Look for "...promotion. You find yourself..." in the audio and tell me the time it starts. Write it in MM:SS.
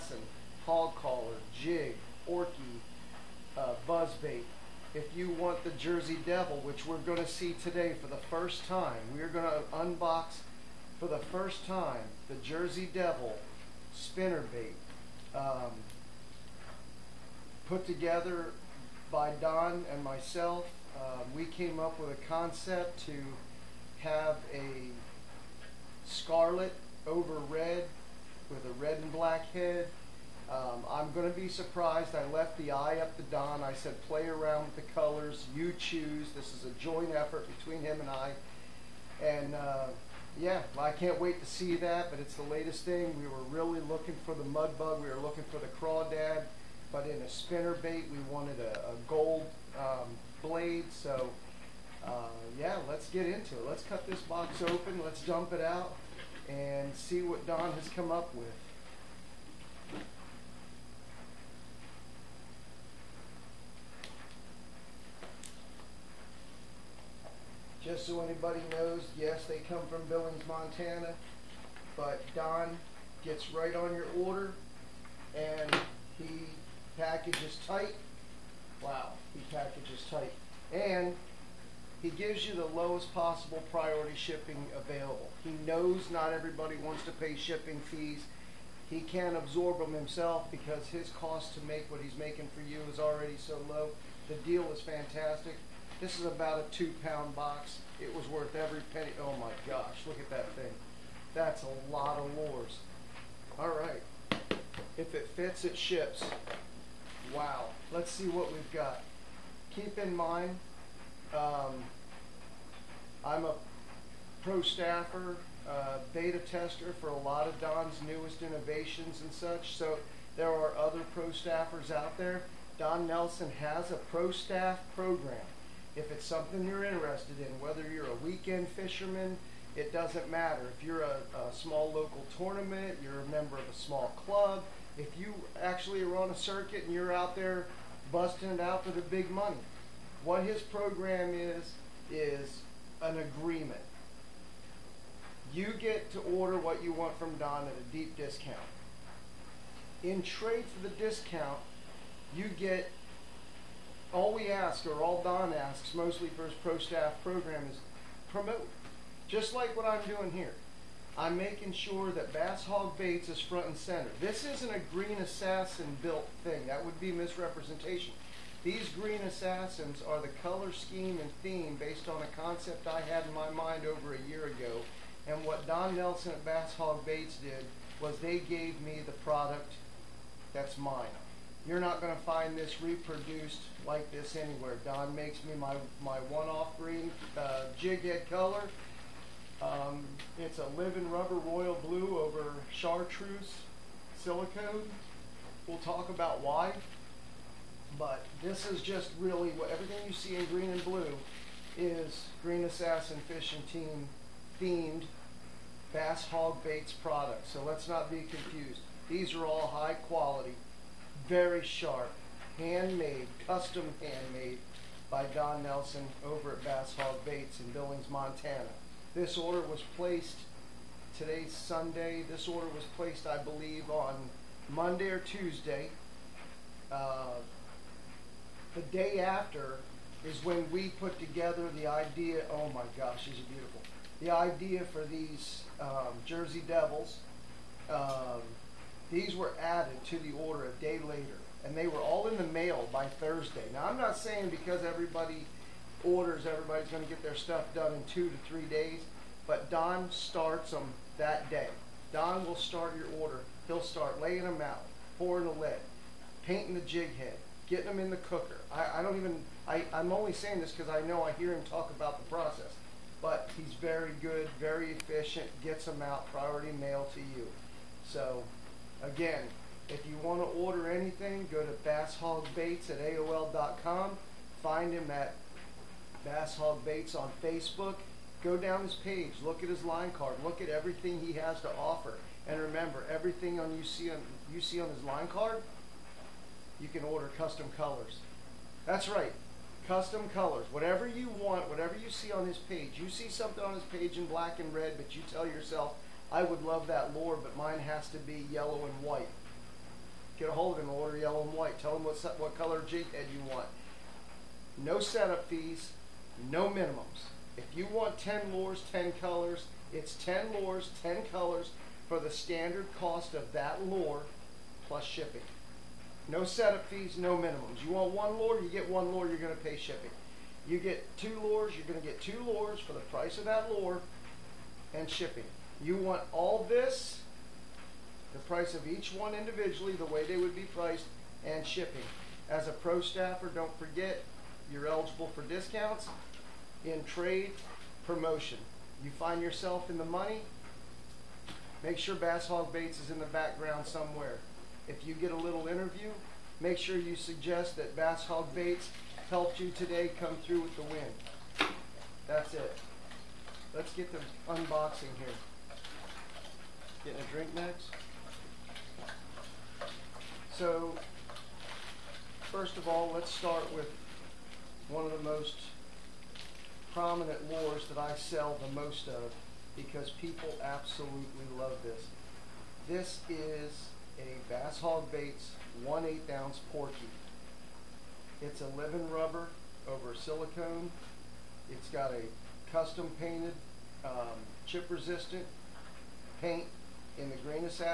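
05:38.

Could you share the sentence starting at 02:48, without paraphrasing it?
These green assassins are the color scheme and theme based on a concept I had in my mind over a year ago.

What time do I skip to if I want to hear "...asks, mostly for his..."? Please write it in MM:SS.
02:35.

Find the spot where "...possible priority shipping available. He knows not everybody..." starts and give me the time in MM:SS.
01:23.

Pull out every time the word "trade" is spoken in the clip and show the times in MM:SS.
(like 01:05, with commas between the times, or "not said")
02:30, 05:37.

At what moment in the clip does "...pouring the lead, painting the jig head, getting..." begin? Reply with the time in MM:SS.
04:15.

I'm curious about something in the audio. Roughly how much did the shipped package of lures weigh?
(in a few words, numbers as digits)
2 pounds.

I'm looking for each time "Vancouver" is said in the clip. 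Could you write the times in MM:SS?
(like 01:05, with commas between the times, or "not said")
not said.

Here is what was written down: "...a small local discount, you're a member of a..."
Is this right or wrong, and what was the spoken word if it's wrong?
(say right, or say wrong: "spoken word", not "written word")
wrong: "tournament", not "discount".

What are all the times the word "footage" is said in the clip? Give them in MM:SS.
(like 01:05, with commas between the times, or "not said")
not said.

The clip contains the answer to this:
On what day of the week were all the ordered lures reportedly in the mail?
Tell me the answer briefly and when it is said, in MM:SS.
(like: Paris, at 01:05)
Thursday, at 04:03.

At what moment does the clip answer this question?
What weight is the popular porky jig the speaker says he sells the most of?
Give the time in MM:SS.
06:15.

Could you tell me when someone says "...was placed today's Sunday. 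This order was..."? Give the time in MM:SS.
03:39.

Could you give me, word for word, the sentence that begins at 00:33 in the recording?
I said, play around with the colors.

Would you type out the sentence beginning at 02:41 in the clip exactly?
I'm making sure that Bass Hawg Baits is front and center.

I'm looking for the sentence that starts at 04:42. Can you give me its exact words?
And remember, everything on you see on, you see on his line card, you can order custom colors.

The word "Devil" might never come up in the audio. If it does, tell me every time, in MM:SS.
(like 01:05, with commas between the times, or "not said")
00:06, 00:12, 03:56.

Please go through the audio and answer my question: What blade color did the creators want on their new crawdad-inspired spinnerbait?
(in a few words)
Gold.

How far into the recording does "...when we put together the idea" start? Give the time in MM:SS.
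03:50.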